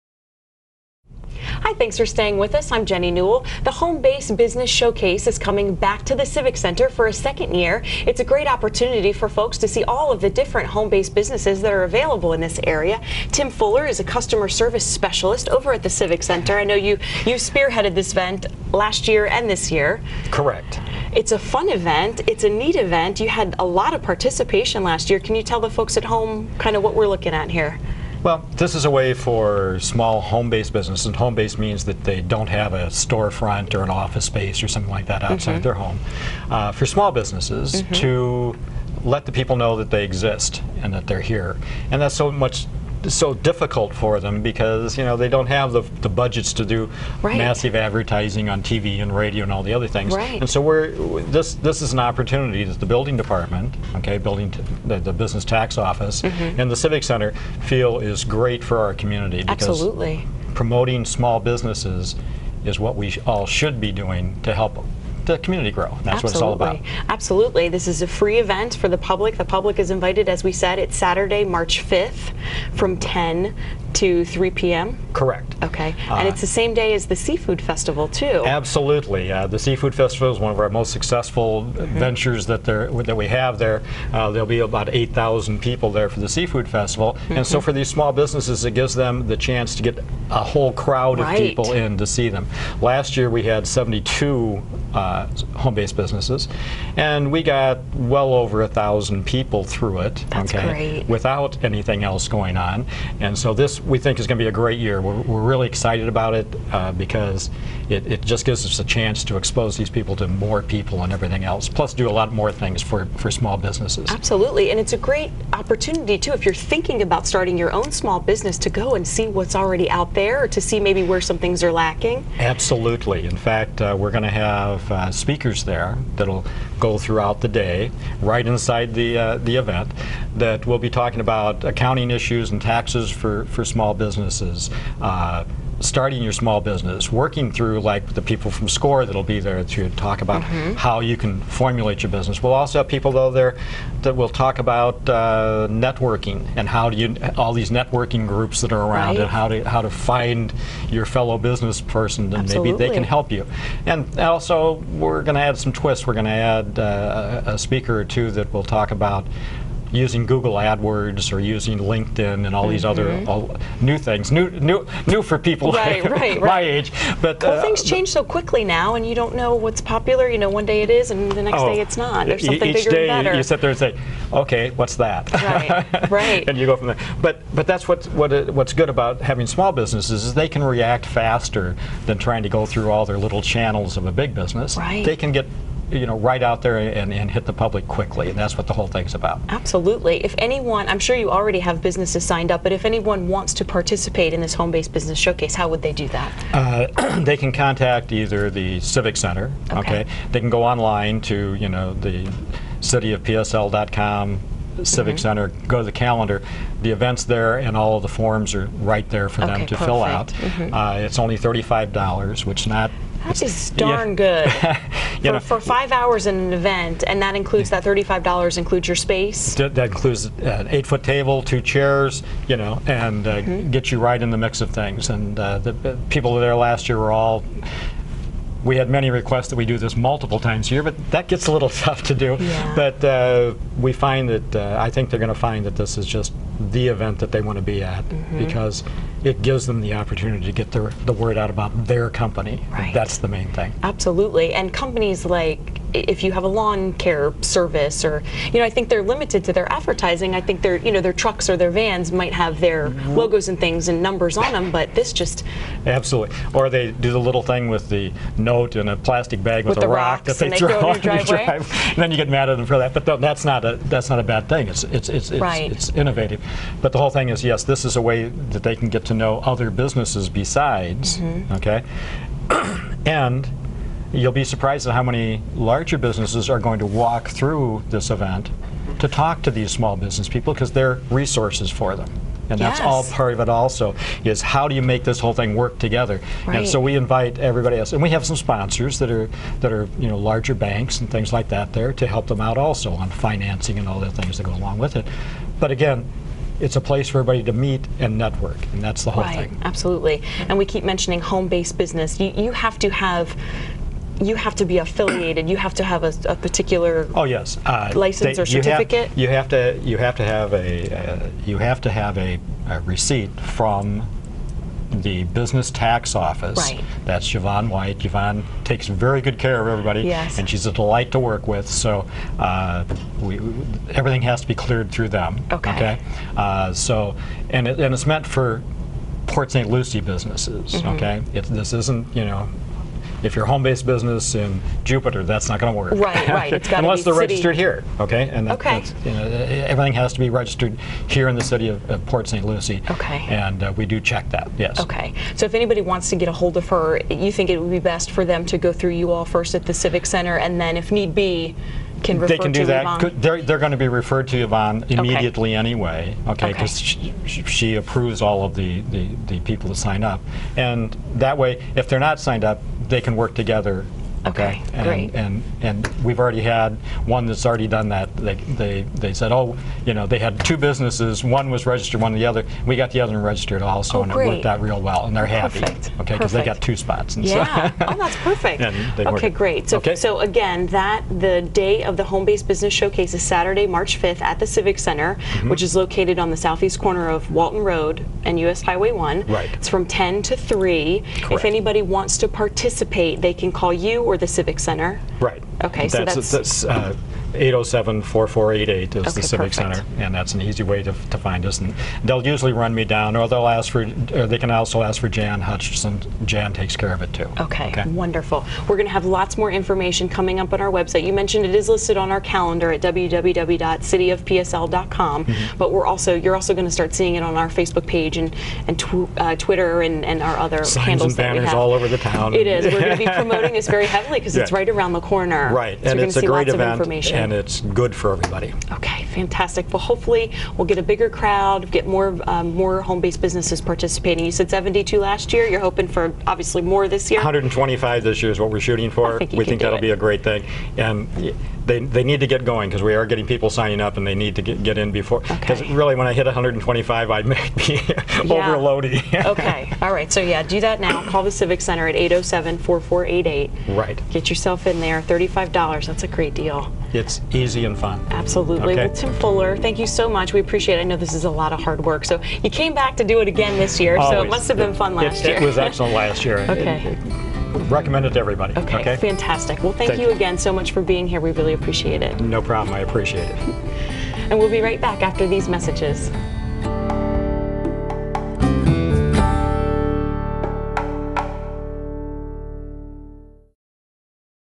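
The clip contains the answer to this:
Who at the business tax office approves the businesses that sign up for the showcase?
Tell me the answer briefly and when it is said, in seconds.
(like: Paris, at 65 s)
Yvonne White, at 317 s.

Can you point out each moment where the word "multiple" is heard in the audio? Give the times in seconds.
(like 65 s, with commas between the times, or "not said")
229 s.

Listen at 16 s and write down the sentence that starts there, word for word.
I know you, you spearheaded this event last year and this year.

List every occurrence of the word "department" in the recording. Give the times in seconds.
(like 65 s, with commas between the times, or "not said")
53 s.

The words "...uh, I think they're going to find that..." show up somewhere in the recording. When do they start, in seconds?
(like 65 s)
234 s.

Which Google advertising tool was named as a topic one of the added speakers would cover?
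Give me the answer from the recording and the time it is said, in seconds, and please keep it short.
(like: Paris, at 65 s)
Google AdWords, at 160 s.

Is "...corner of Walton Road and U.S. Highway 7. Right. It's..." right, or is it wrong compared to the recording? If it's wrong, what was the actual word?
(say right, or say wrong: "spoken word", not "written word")
wrong: "1", not "7".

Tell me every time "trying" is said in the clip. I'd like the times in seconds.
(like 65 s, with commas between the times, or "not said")
182 s.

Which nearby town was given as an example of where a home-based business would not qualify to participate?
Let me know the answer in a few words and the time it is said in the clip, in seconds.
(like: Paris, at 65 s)
Jupiter, at 334 s.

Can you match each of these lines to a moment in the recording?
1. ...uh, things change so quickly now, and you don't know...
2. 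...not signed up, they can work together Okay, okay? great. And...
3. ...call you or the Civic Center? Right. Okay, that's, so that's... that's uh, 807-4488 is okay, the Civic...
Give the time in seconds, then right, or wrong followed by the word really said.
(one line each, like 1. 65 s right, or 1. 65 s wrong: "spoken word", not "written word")
1. 167 s right
2. 361 s right
3. 393 s right.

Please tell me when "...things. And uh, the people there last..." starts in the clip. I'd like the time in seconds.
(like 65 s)
224 s.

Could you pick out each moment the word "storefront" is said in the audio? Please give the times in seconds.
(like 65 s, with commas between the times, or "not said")
32 s.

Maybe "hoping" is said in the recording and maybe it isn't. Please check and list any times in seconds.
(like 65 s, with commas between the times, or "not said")
435 s.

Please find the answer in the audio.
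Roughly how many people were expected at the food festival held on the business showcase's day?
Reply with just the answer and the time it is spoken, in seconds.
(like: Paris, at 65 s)
8,000, at 84 s.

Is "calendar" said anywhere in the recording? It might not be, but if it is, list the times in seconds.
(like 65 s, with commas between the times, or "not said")
205 s, 412 s.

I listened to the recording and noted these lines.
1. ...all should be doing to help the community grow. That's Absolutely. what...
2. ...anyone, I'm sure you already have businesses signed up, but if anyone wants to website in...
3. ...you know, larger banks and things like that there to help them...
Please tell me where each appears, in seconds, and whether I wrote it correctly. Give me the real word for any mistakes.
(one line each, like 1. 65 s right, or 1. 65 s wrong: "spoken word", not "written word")
1. 63 s right
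2. 190 s wrong: "participate", not "website"
3. 289 s right.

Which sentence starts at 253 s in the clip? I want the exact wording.
logos and things and numbers on them, but this just absolutely.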